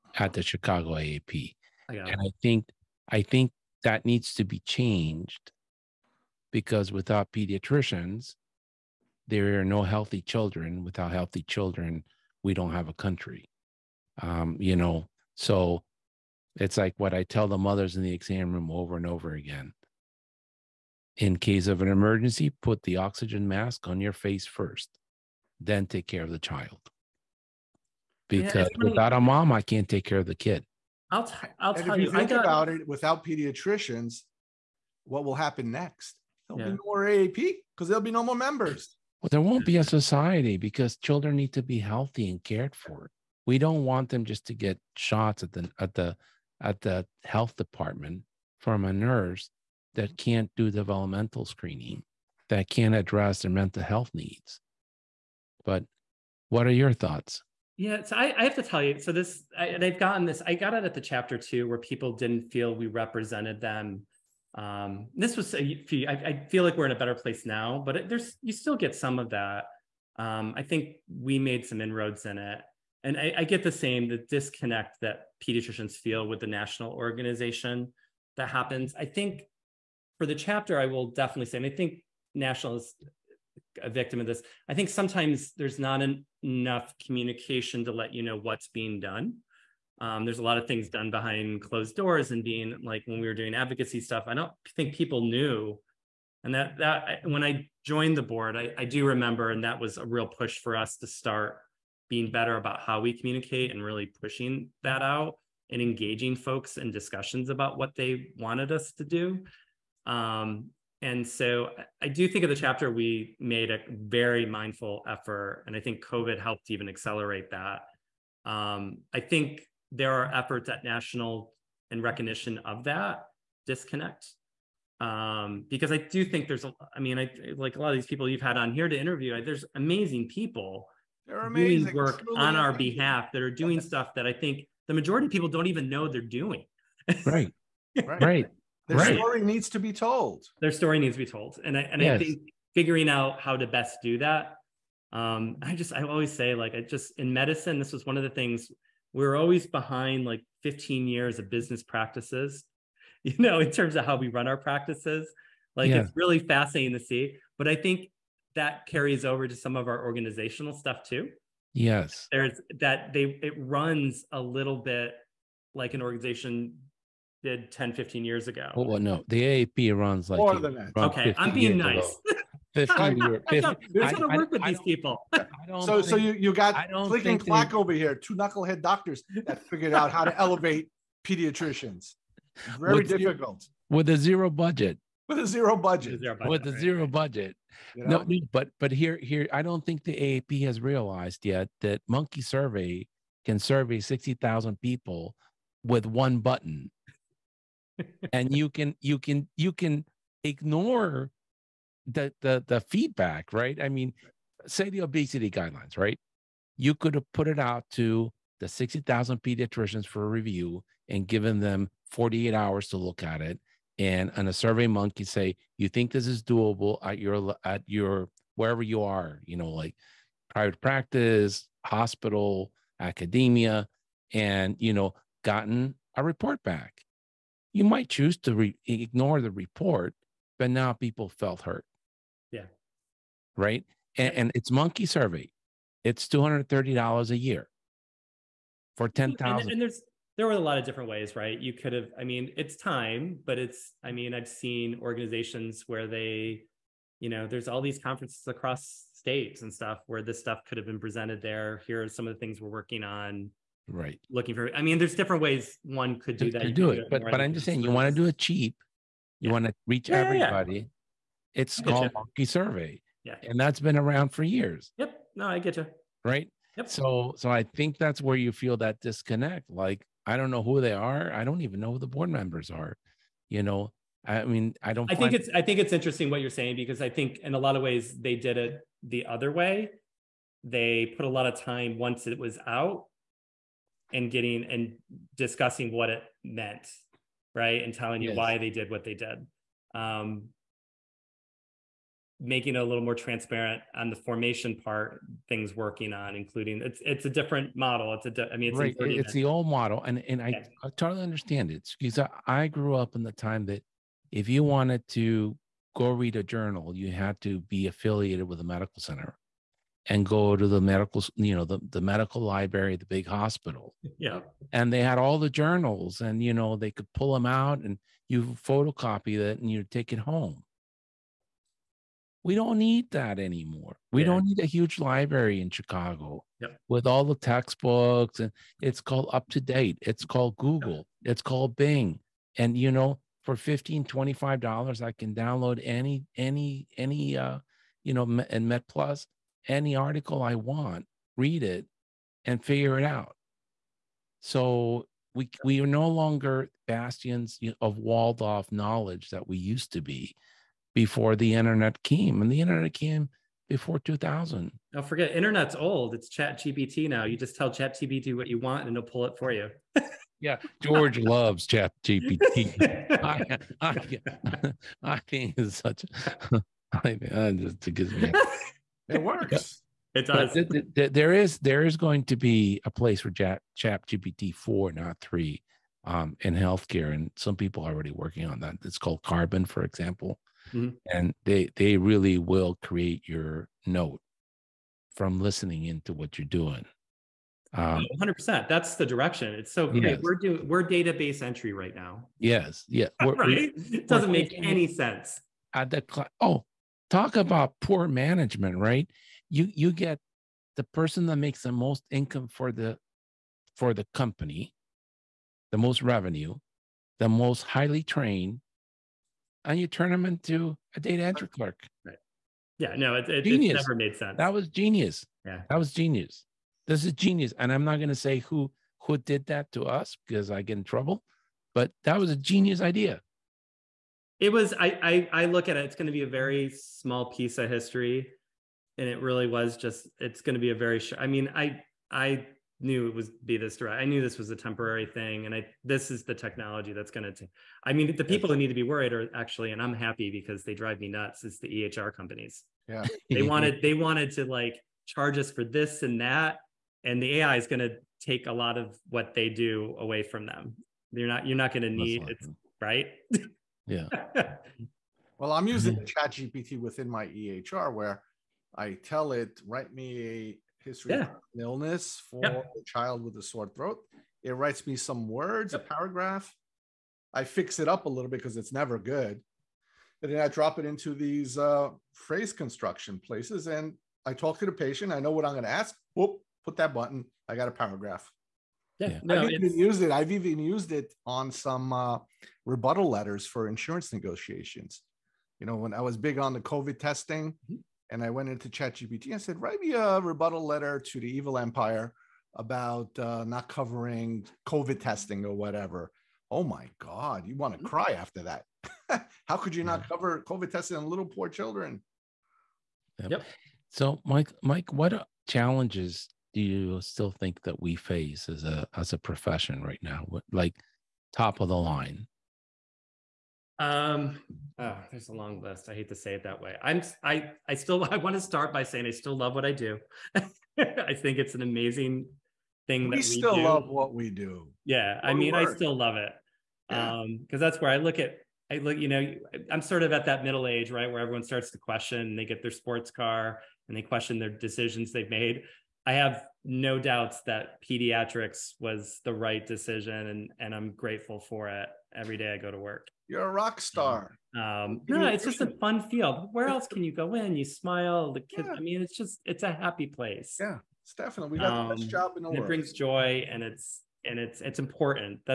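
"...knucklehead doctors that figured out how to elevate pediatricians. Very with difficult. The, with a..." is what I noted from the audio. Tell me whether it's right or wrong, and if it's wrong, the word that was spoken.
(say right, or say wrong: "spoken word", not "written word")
right.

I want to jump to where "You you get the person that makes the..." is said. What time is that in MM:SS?
06:39.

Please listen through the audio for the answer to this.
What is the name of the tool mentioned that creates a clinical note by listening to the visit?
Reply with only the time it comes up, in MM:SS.
06:19.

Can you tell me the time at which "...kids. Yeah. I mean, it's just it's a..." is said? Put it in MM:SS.
09:08.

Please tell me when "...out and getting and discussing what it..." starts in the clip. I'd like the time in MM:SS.
04:42.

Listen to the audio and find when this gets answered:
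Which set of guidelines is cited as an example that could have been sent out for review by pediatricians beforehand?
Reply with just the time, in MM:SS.
03:25.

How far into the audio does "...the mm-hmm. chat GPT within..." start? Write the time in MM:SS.
07:35.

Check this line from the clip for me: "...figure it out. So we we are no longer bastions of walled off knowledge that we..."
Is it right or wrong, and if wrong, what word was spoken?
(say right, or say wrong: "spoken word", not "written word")
right.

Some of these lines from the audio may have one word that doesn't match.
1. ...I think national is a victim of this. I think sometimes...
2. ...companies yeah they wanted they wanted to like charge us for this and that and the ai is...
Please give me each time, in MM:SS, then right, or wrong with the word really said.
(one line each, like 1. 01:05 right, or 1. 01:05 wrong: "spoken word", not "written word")
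1. 01:21 right
2. 07:22 right.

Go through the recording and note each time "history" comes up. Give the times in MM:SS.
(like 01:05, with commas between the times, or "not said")
07:07, 07:40.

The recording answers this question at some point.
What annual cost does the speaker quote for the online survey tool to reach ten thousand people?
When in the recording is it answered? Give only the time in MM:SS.
03:56.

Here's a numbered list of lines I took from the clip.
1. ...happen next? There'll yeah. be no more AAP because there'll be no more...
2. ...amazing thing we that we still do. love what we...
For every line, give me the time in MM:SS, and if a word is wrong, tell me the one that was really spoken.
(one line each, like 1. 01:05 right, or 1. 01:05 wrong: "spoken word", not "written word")
1. 00:35 right
2. 08:41 right.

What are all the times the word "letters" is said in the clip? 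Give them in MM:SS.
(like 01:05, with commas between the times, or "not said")
08:03, 08:10.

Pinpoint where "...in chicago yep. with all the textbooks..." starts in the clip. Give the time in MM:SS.
05:25.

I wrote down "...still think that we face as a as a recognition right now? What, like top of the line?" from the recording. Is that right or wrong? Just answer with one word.
wrong.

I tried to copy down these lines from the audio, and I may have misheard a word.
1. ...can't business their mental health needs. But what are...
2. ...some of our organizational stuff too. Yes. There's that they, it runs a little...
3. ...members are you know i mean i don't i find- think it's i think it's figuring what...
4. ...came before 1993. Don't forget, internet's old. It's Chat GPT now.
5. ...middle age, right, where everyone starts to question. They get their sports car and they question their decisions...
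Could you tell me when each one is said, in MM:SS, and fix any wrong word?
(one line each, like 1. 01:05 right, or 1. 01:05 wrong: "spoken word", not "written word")
1. 00:52 wrong: "address", not "business"
2. 02:39 right
3. 04:32 wrong: "interesting", not "figuring"
4. 05:52 wrong: "2000", not "1993"
5. 08:50 right.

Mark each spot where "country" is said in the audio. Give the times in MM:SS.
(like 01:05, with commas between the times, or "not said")
00:12.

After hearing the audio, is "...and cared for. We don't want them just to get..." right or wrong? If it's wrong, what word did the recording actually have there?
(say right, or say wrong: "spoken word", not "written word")
right.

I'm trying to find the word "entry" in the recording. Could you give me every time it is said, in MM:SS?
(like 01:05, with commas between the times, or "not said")
06:31, 06:51.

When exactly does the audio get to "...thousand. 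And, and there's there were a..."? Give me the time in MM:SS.
03:59.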